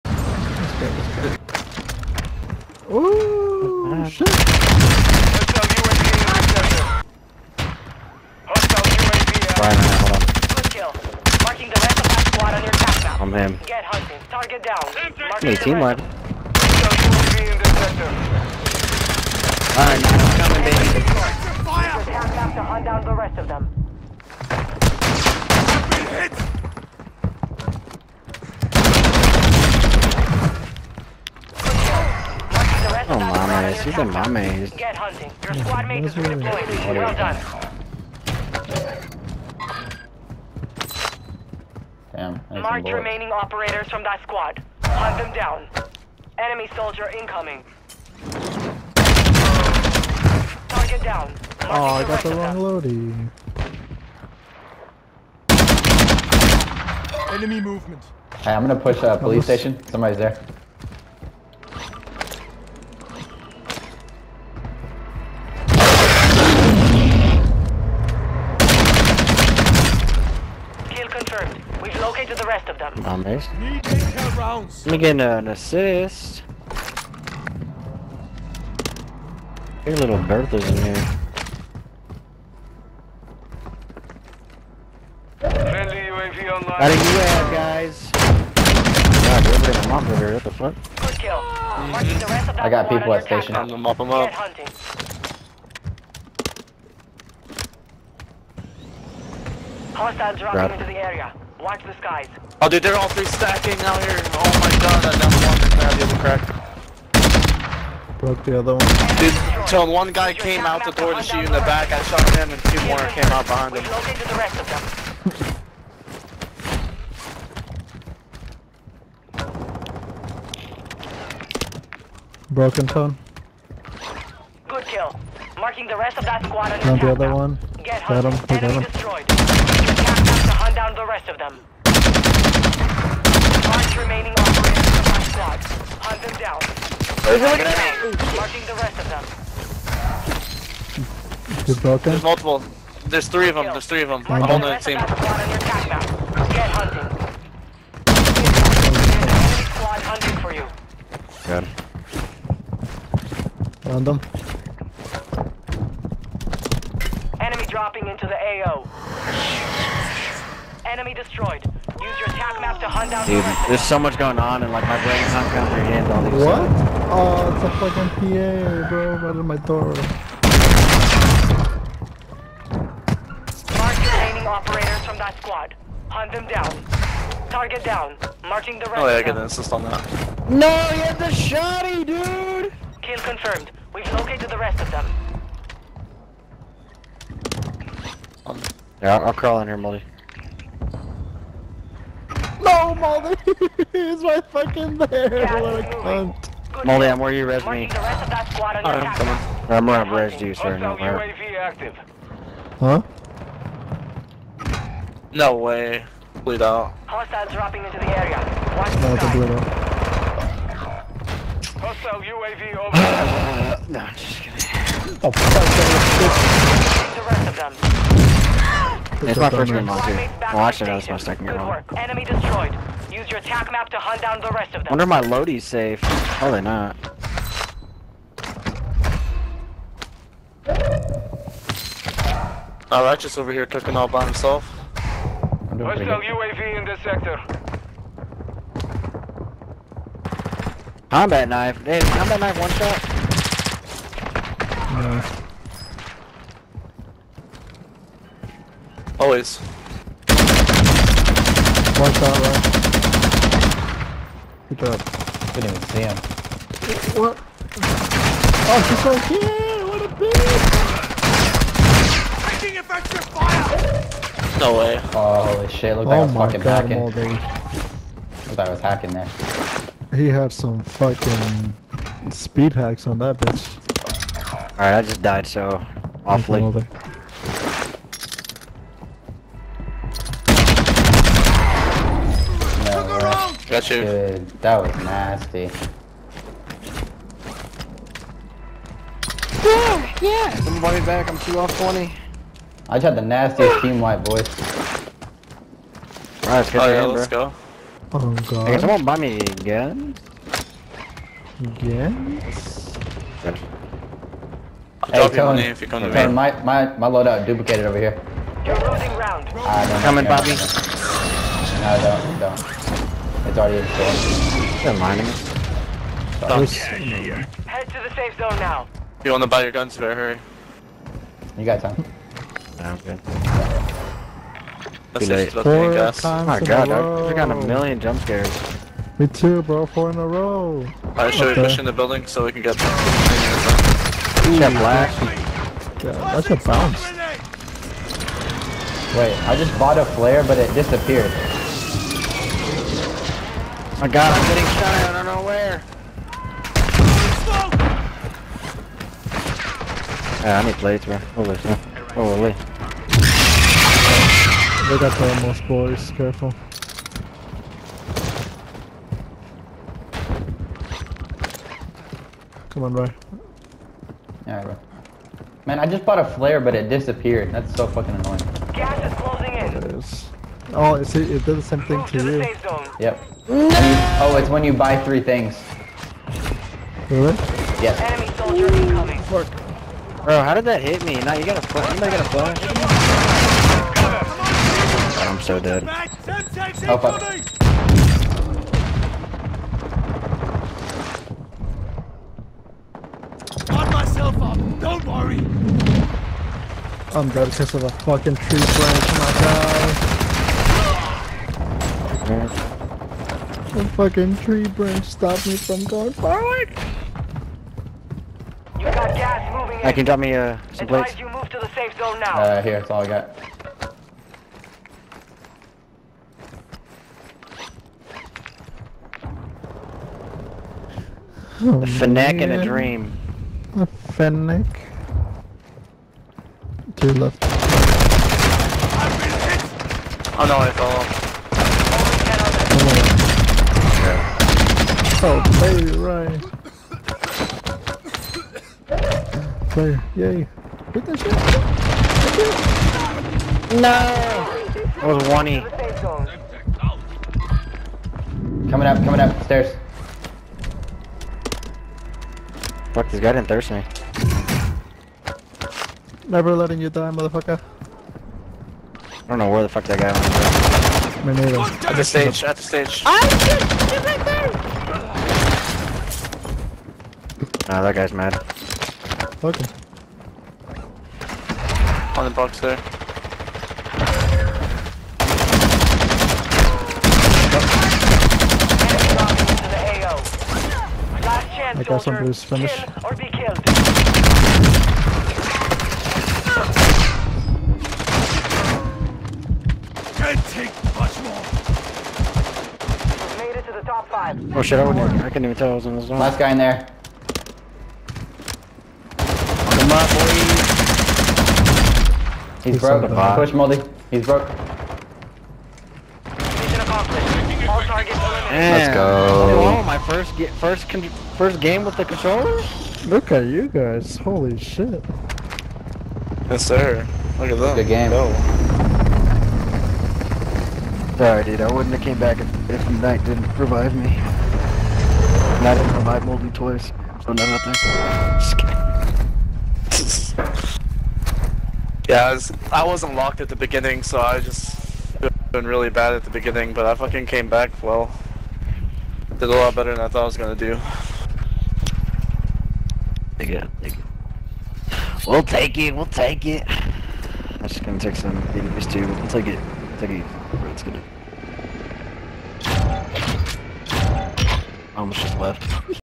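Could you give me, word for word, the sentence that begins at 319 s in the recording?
You want to buy your guns, better hurry.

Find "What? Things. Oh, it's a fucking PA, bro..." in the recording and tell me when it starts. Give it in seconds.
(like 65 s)
166 s.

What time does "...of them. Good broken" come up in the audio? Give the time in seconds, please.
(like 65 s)
140 s.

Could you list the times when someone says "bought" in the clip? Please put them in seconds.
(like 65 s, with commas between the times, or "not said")
339 s, 366 s.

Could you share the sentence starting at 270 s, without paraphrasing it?
He had some fucking speed hacks on that bitch.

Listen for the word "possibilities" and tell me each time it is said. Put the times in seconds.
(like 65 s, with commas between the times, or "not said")
not said.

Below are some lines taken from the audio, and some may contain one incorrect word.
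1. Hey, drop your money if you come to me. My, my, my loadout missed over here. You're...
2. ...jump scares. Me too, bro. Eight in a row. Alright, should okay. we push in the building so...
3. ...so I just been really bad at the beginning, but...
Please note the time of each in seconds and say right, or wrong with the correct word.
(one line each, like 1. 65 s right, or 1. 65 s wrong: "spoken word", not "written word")
1. 303 s wrong: "duplicated", not "missed"
2. 327 s wrong: "Four", not "Eight"
3. 534 s right.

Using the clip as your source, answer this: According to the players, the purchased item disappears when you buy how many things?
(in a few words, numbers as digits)
3.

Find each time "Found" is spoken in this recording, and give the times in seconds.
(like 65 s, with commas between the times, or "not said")
153 s.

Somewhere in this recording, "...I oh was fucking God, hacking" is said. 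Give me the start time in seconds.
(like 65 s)
266 s.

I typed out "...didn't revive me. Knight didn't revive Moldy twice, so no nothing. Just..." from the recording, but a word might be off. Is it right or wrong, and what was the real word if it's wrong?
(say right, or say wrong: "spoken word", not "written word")
right.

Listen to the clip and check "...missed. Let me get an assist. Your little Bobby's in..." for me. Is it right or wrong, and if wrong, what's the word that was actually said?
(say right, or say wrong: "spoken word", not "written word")
wrong: "Bertha", not "Bobby".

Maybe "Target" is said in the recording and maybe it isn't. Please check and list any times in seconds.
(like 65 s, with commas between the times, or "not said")
14 s, 50 s, 177 s.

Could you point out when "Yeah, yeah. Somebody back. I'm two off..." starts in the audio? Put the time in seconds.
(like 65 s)
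289 s.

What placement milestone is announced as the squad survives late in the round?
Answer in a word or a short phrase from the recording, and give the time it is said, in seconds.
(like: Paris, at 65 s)
top five, at 493 s.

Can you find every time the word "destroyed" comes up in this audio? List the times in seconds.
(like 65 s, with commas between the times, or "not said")
128 s, 161 s, 222 s.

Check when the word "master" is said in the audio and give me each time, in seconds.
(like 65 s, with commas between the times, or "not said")
not said.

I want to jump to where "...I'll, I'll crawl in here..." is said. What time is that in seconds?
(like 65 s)
189 s.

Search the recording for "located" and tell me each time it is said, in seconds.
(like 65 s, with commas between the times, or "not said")
72 s, 184 s.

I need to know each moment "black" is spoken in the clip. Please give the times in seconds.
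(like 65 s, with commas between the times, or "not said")
334 s.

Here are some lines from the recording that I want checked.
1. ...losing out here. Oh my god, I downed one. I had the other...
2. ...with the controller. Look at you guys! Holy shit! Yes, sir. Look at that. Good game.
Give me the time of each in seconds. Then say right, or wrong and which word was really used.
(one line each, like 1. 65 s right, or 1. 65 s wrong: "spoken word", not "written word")
1. 103 s wrong: "stacking", not "losing"
2. 511 s right.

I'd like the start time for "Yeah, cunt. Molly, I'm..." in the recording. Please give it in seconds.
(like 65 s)
195 s.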